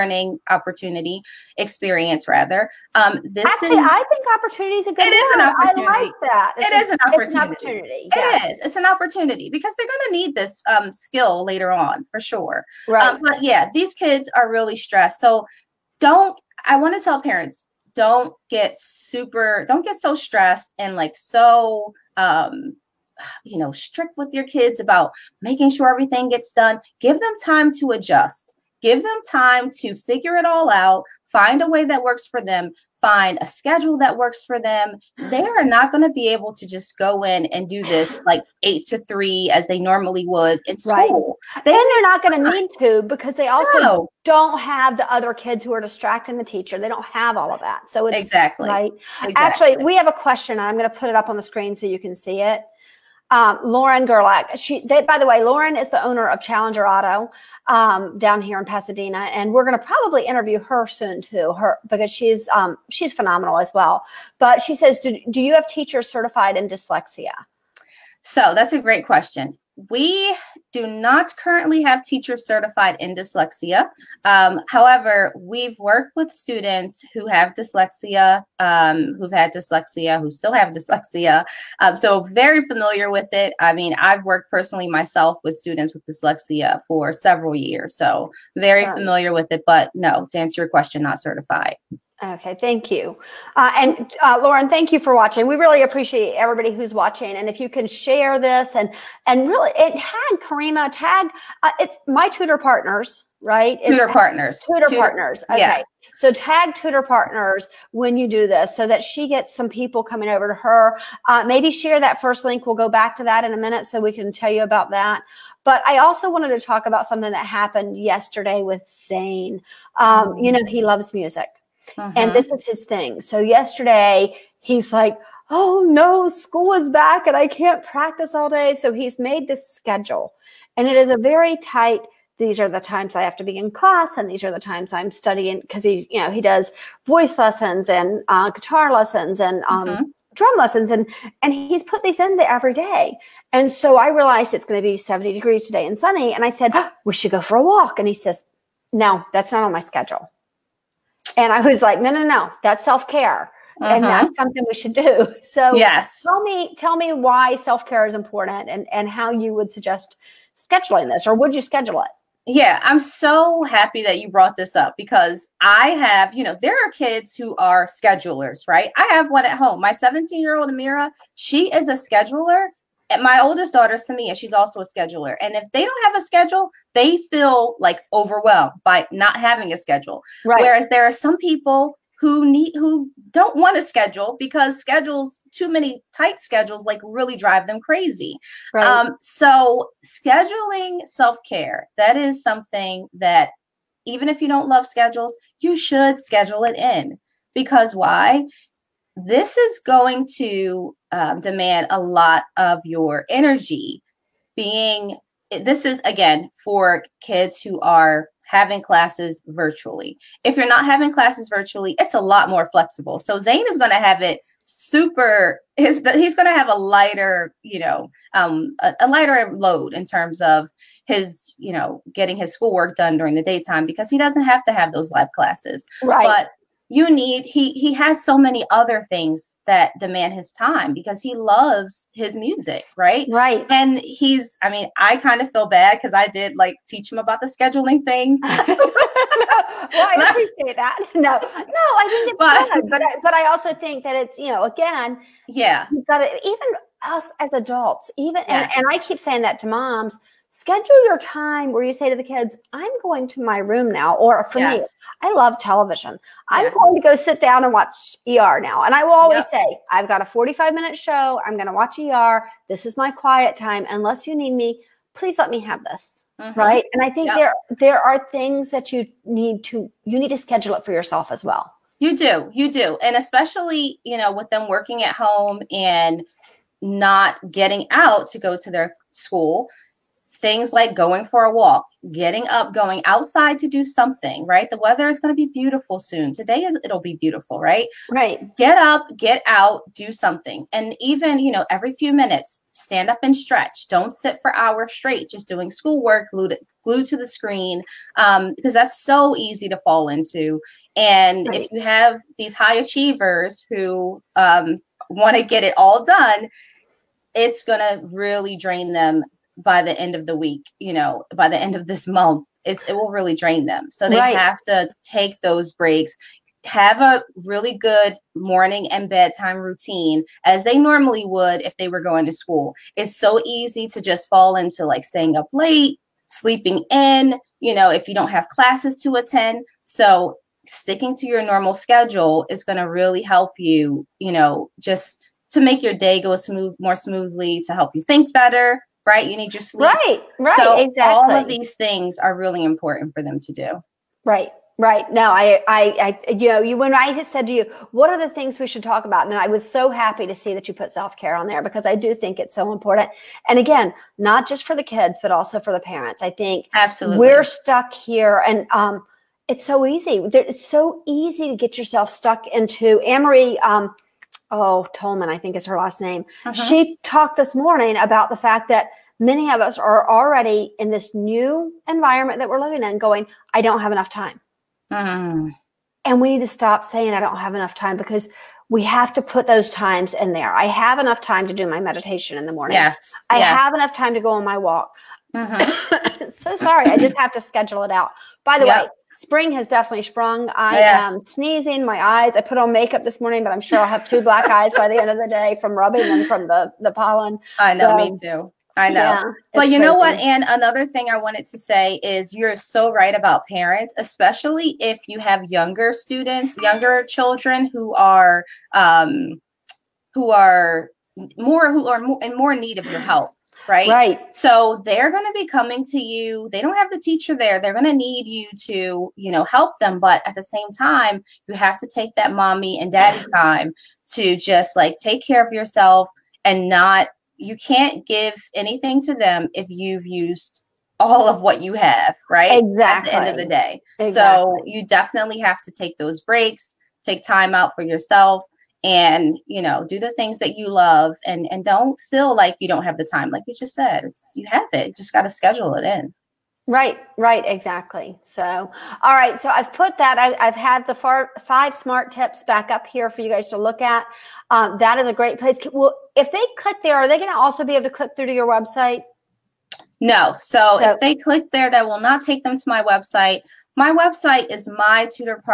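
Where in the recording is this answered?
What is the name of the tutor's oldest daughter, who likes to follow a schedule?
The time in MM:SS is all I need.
02:53.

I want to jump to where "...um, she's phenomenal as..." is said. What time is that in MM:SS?
01:02.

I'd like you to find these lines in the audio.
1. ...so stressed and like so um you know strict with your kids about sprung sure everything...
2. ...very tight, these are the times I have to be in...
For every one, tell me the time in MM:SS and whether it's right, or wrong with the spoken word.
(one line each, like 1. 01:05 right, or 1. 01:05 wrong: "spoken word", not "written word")
1. 00:19 wrong: "making", not "sprung"
2. 02:11 right.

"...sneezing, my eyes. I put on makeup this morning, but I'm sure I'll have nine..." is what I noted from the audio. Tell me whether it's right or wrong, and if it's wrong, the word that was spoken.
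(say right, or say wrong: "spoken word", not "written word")
wrong: "two", not "nine".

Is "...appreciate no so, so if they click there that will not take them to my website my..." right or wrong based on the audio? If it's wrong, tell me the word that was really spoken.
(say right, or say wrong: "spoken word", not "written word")
wrong: "website", not "appreciate".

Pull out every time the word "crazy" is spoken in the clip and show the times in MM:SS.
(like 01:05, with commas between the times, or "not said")
03:07, 06:39.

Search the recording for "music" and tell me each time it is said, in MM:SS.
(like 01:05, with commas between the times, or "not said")
02:01, 03:52.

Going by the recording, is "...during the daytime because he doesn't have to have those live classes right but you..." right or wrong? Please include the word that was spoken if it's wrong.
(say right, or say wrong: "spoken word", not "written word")
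right.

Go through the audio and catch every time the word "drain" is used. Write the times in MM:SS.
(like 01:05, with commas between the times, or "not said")
05:08, 05:13.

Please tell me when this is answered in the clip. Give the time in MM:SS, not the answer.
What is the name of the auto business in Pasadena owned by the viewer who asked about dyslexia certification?
00:56.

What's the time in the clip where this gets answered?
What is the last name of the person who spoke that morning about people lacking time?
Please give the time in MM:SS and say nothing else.
06:04.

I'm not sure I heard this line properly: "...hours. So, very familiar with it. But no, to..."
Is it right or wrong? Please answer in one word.
wrong.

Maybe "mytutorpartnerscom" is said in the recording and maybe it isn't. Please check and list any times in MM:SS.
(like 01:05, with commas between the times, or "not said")
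07:44.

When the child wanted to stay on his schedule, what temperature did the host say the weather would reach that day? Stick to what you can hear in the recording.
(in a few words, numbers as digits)
70 degrees.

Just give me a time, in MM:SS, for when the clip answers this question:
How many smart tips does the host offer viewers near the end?
07:31.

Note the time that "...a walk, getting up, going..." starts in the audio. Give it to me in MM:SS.
04:41.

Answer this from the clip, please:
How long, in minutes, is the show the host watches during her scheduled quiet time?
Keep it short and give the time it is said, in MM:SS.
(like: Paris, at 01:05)
45, at 04:20.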